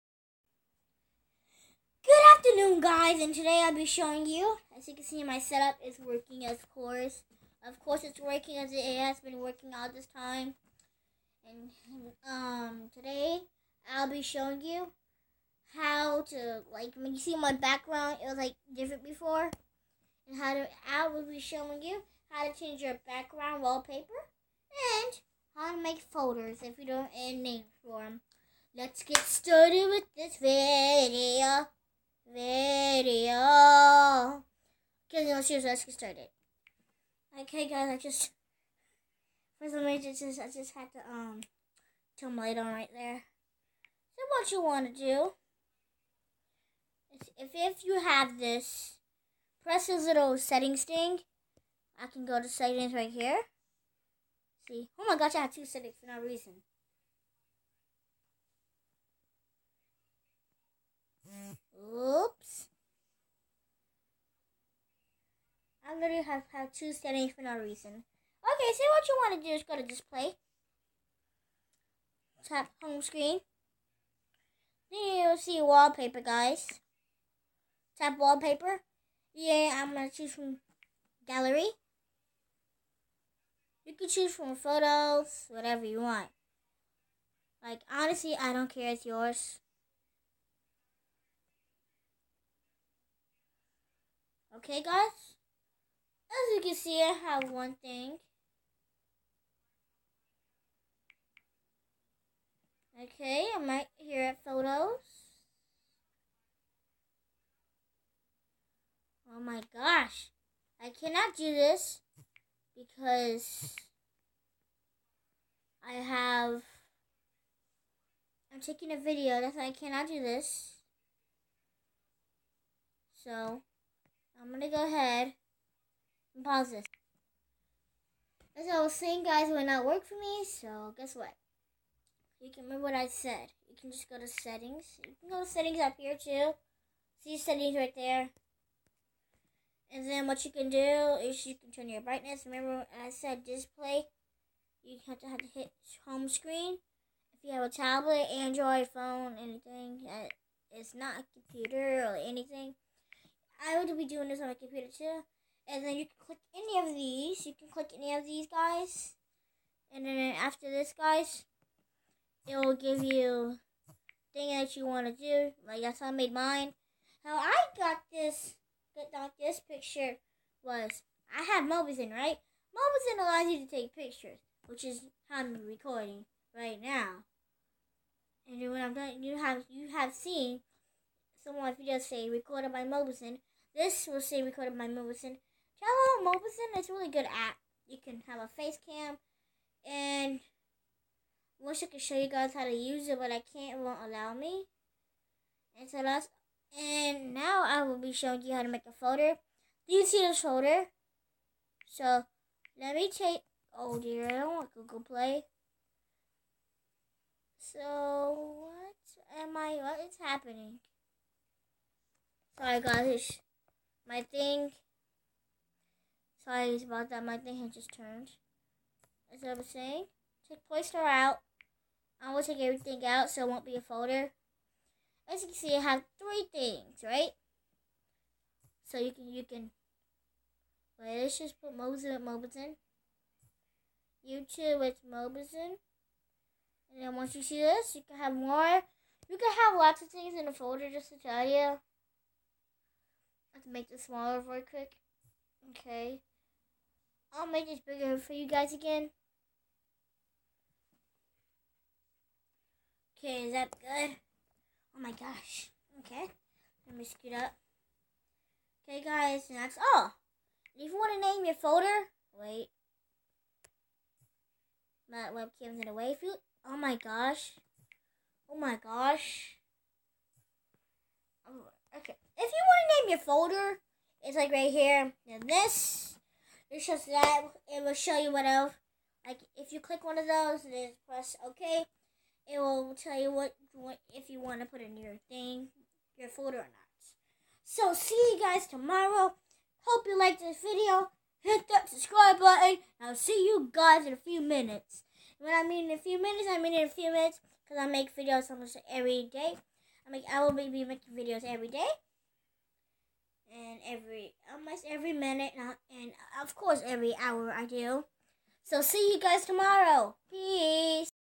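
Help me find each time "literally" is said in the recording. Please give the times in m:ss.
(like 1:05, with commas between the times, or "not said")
1:05.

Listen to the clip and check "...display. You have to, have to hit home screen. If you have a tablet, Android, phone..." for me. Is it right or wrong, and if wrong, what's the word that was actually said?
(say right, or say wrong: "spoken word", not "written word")
right.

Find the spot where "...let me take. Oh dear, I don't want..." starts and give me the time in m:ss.
3:22.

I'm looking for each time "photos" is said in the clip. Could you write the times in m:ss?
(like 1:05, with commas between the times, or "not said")
1:24, 1:44.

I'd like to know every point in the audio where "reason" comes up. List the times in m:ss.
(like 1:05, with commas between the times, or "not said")
0:39, 0:56, 1:07.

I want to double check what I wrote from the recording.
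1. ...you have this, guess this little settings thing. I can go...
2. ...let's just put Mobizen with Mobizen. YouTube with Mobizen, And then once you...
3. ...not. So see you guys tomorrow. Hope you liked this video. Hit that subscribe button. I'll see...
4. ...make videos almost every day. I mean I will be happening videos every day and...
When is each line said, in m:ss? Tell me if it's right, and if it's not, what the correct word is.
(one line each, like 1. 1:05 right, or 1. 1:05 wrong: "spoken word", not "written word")
1. 0:47 wrong: "press", not "guess"
2. 3:51 right
3. 4:46 right
4. 4:57 wrong: "making", not "happening".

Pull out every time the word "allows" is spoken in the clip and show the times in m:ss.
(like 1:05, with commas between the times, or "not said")
2:53, 3:14.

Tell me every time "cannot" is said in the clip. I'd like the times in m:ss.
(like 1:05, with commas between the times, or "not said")
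1:50, 1:59.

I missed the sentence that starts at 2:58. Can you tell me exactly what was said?
And then when I'm done, you have you have seen some of my videos say recorded by Mobizen.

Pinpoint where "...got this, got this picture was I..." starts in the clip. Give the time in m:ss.
2:47.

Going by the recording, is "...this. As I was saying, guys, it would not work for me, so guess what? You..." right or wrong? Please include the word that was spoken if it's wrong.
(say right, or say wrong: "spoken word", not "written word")
right.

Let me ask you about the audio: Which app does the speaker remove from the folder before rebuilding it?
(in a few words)
Playster.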